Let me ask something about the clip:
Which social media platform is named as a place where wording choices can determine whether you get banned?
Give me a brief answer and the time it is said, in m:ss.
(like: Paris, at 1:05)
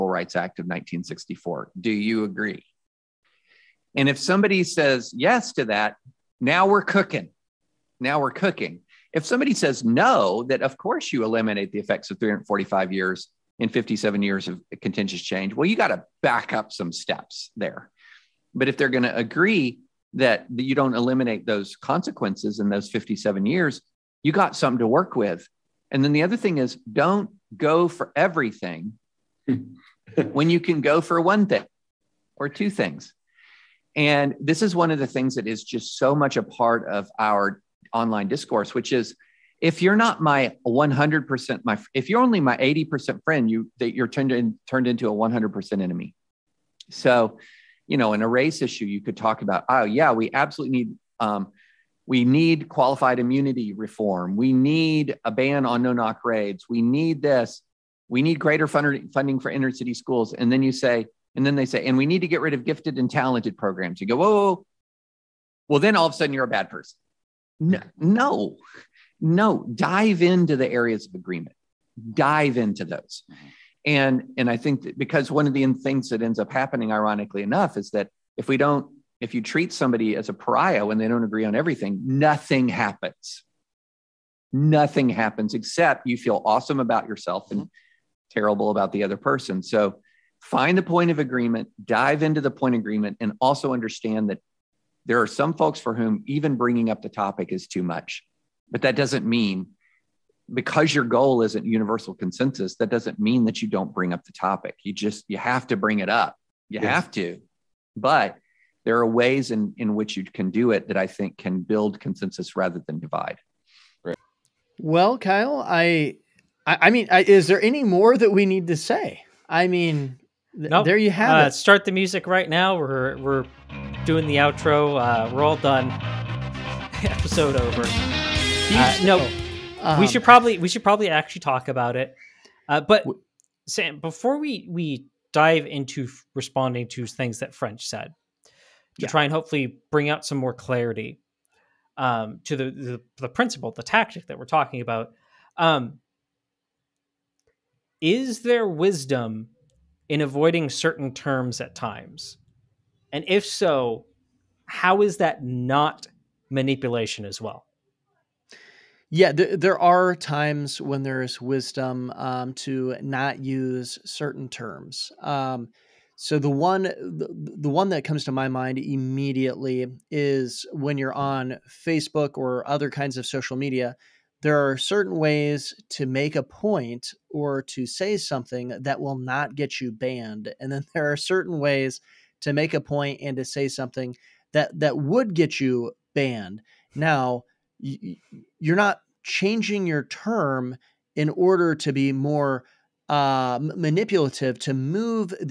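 Facebook, at 2:51.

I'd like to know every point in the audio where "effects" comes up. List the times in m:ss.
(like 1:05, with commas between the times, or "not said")
0:11.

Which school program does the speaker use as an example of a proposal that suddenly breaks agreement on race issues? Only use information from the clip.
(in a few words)
gifted and talented programs.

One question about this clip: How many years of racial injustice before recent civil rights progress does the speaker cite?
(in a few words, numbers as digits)
345.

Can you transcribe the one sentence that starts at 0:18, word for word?
But if they're going to agree that you don't eliminate those consequences in those 57 years, you got something to work with.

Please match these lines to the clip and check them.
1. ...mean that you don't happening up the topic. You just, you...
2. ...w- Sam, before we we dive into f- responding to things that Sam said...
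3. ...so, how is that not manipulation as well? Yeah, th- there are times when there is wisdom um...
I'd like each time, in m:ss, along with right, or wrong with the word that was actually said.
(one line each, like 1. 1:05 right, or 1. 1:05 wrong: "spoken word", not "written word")
1. 1:43 wrong: "bring", not "happening"
2. 2:13 wrong: "French", not "Sam"
3. 2:33 right.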